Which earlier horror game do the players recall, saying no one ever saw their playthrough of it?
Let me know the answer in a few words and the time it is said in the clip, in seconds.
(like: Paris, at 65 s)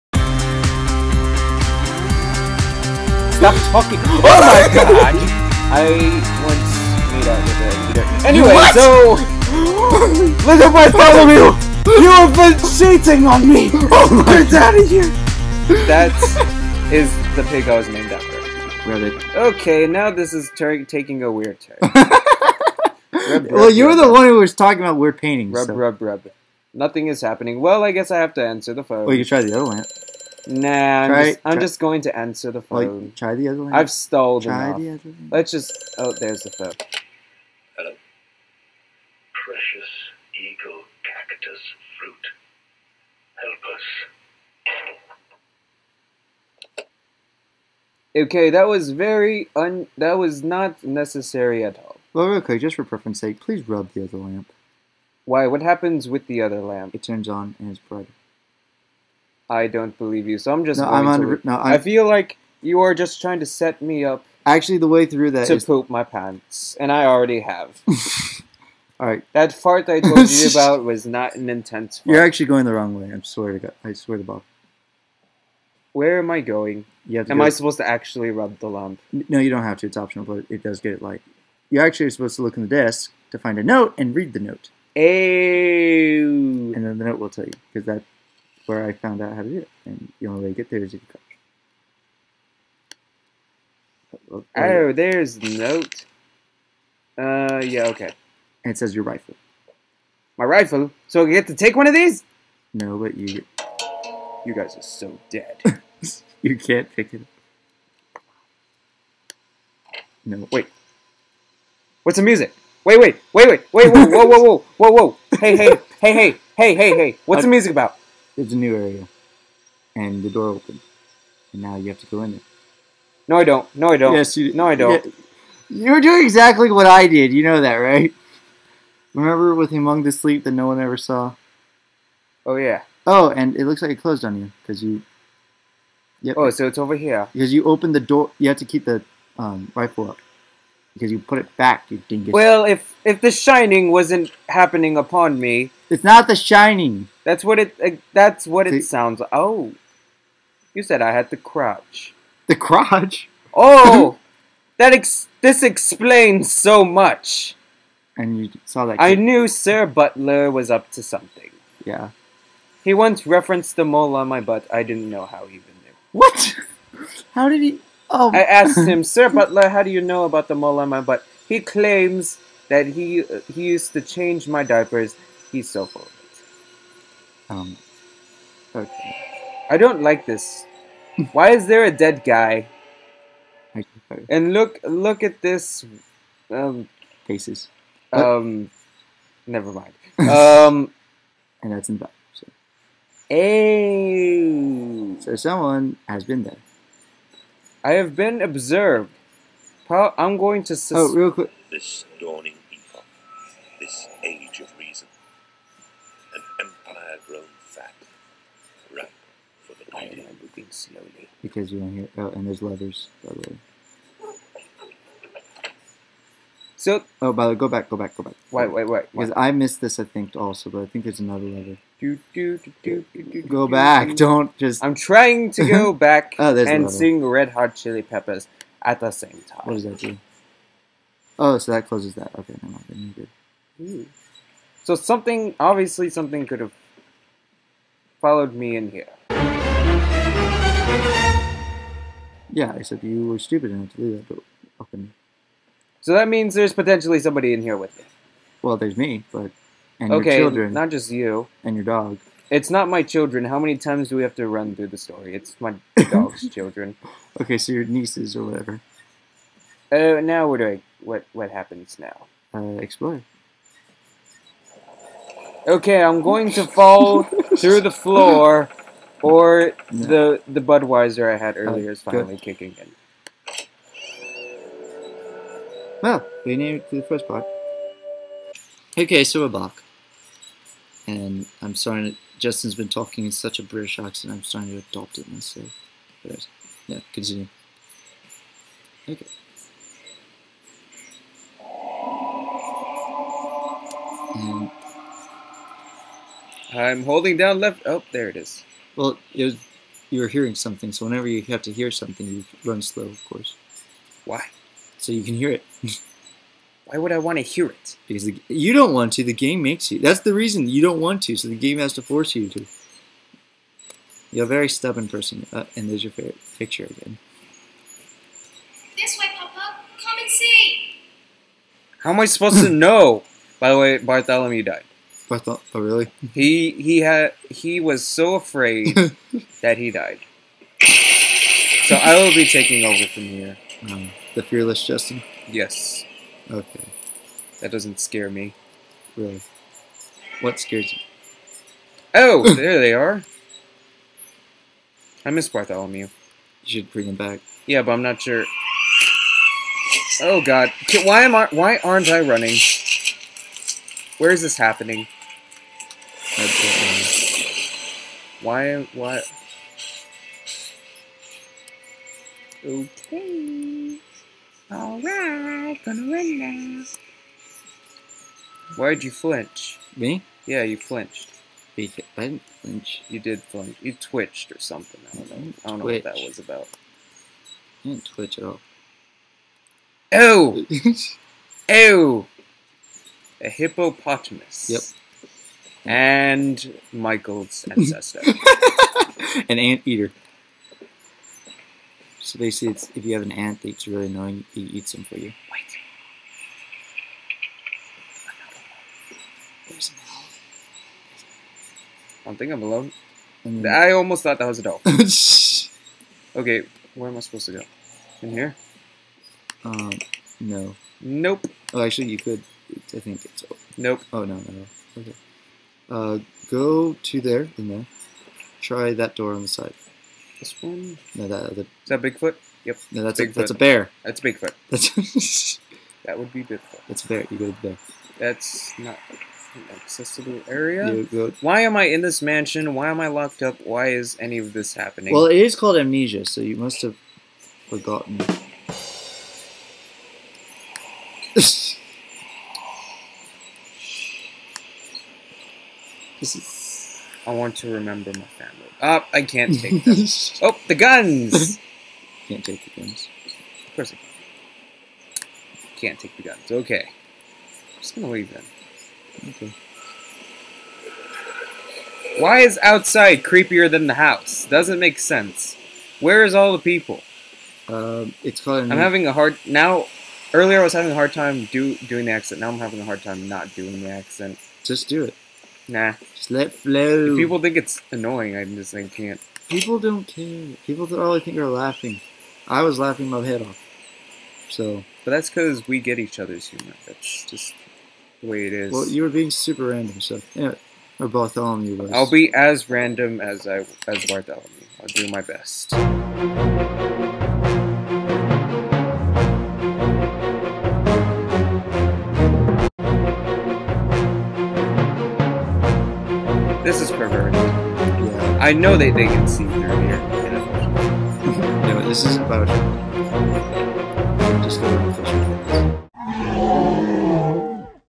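Among the Sleep, at 129 s.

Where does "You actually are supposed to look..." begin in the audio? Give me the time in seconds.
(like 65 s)
81 s.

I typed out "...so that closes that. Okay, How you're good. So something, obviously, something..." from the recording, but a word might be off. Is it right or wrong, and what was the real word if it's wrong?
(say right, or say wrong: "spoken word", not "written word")
wrong: "Then", not "How".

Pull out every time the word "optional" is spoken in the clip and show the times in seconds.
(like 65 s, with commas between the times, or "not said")
79 s.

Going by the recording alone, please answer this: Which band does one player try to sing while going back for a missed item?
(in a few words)
Red Hot Chili Peppers.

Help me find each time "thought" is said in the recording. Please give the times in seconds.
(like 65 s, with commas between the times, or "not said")
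325 s, 404 s.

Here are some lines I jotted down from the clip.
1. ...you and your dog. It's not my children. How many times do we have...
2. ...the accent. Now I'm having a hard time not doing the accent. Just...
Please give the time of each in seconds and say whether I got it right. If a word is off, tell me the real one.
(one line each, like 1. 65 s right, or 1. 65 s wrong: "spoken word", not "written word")
1. 251 s right
2. 472 s right.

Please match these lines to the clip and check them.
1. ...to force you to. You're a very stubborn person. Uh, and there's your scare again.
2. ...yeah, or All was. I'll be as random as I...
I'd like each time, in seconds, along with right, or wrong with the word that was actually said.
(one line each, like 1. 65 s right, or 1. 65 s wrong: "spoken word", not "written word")
1. 311 s wrong: "picture", not "scare"
2. 490 s wrong: "Bartholomew", not "All".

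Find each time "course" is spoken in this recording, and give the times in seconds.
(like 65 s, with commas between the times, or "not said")
303 s, 453 s.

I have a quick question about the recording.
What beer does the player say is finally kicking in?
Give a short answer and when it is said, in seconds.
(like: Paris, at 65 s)
Budweiser, at 270 s.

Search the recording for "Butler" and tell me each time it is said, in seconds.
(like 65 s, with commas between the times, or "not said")
159 s, 169 s.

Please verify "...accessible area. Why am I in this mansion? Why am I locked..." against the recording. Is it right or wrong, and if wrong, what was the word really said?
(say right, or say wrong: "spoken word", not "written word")
right.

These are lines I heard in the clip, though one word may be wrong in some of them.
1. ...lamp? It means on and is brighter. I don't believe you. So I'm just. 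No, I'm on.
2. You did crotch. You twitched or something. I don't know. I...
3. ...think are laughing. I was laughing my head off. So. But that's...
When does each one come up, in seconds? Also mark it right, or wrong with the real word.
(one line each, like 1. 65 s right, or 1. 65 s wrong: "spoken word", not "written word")
1. 56 s wrong: "turns", not "means"
2. 373 s wrong: "flinch", not "crotch"
3. 481 s right.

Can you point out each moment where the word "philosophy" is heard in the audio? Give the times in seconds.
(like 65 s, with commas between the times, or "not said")
not said.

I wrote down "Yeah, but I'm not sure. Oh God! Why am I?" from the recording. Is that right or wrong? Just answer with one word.
right.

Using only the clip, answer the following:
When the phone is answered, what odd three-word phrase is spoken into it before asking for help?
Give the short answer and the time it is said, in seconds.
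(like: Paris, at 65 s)
Precious eagle cactus fruit, at 39 s.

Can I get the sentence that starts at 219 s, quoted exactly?
Because I missed this, I think, also, but I think there's another leather.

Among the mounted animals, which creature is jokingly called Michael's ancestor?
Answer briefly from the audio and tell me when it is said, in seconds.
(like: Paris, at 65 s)
ant eater, at 389 s.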